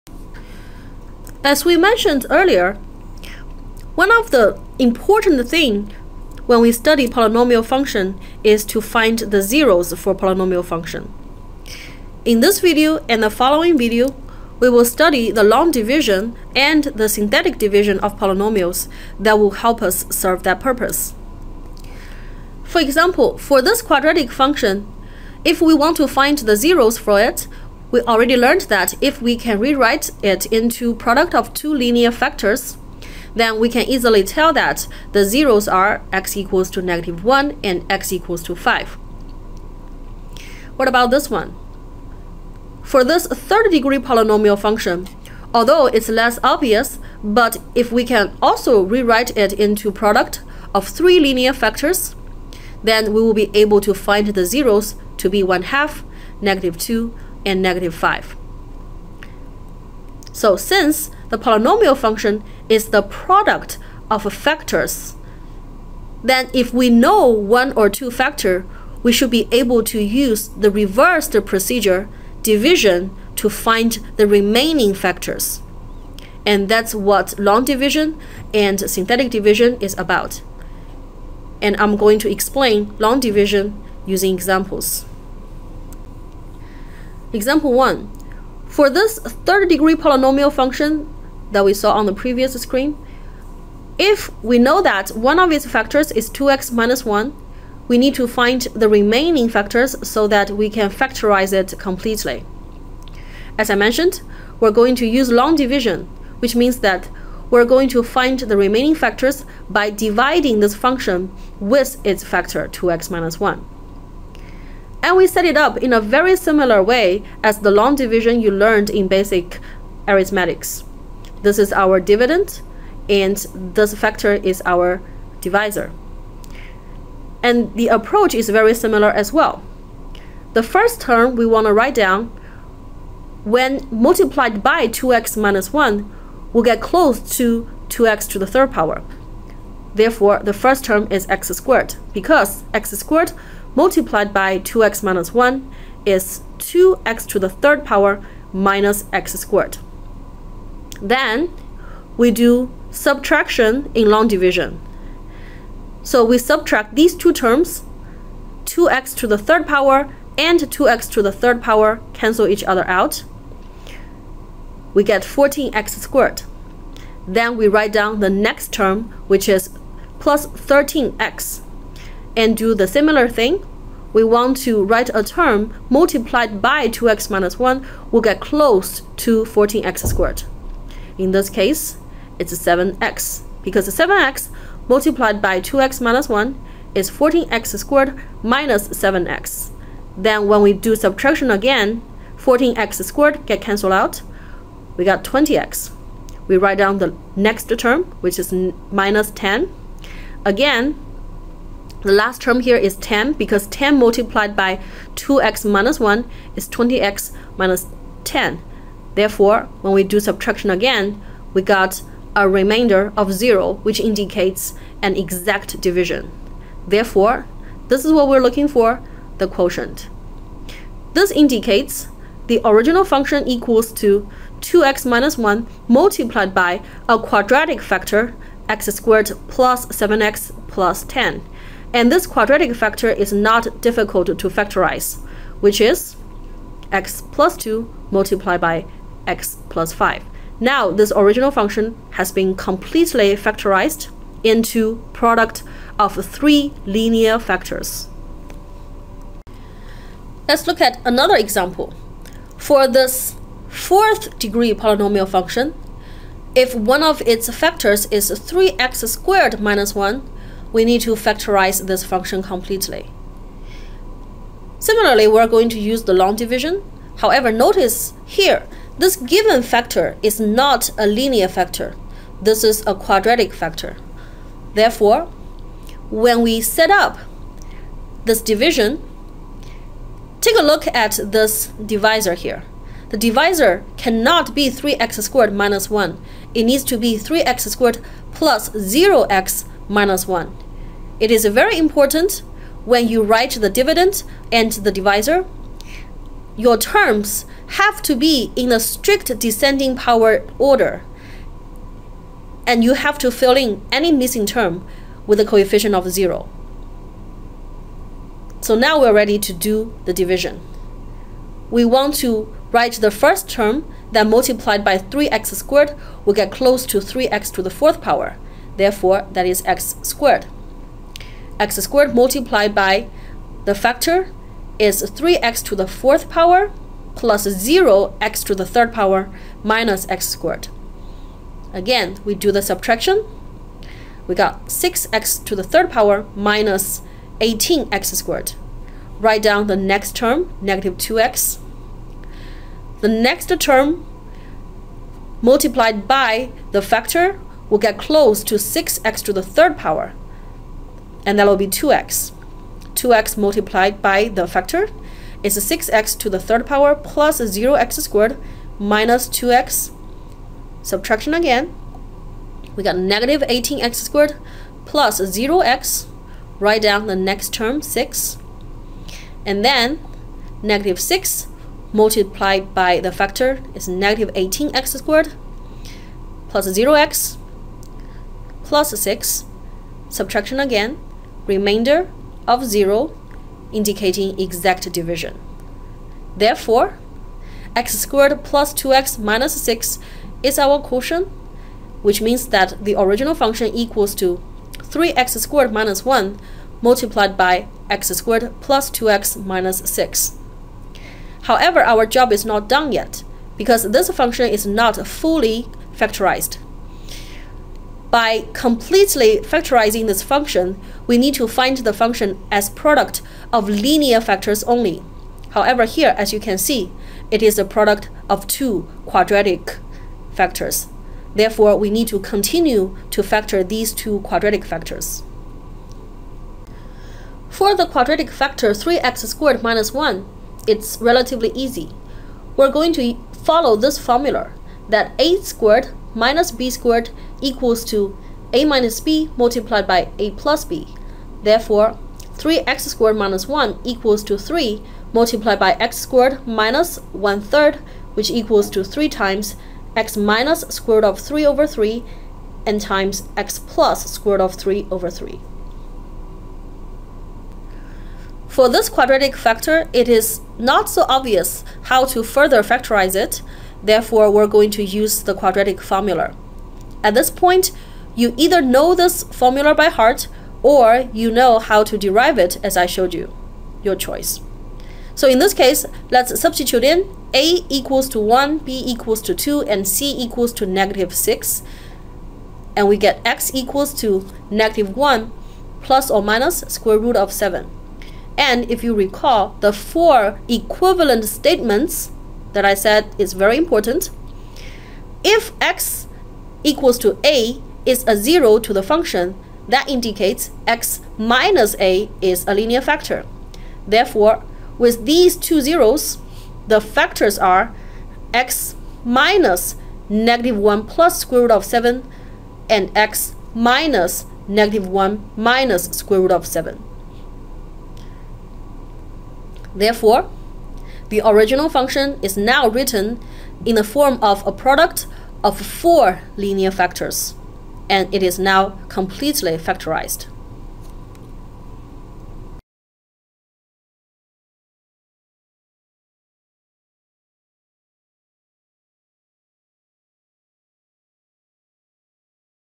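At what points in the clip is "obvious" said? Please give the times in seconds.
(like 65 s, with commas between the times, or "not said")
46 s, 461 s.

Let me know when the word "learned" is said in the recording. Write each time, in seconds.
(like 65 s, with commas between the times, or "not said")
28 s, 118 s.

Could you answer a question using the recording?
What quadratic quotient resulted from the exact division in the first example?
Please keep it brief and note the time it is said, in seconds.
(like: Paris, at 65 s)
x^2 + 7x + 10, at 228 s.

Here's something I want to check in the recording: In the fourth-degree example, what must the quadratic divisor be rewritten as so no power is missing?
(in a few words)
3x^2 + 0x - 1.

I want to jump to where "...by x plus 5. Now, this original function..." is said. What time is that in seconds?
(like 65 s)
238 s.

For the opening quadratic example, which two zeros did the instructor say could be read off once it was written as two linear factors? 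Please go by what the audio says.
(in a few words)
-1 and 5.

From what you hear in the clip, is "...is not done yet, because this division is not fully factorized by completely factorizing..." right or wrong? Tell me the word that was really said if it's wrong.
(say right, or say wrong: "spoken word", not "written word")
wrong: "function", not "division".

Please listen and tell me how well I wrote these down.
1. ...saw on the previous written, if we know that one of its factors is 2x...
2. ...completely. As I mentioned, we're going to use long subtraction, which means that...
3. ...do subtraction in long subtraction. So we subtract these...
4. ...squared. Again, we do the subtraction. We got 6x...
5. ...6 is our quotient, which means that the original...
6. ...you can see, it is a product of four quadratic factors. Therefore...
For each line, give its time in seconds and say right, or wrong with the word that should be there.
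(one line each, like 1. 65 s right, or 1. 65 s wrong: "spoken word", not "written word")
1. 91 s wrong: "screen", not "written"
2. 101 s wrong: "division", not "subtraction"
3. 152 s wrong: "division", not "subtraction"
4. 330 s right
5. 389 s right
6. 416 s wrong: "two", not "four".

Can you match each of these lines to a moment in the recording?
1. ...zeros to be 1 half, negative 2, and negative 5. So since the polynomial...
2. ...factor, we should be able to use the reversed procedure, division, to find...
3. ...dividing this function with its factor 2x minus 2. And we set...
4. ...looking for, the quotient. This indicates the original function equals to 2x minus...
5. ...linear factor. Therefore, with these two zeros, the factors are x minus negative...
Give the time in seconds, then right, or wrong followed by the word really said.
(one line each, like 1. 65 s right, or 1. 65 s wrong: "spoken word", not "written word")
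1. 54 s right
2. 68 s right
3. 109 s wrong: "1", not "2"
4. 218 s right
5. 502 s right.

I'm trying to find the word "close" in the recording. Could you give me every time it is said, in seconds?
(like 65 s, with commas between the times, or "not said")
136 s, 178 s, 316 s, 347 s.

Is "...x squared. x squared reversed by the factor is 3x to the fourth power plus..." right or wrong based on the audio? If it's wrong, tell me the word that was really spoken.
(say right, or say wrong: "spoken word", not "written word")
wrong: "multiplied", not "reversed".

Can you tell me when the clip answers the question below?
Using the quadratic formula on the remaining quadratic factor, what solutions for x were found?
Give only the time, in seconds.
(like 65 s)
484 s.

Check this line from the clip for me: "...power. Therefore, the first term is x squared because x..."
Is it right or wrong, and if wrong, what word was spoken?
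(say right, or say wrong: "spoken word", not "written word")
right.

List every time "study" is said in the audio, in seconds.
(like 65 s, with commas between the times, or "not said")
6 s, 14 s.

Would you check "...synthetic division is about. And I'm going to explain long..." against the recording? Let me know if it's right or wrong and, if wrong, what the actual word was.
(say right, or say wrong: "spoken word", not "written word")
right.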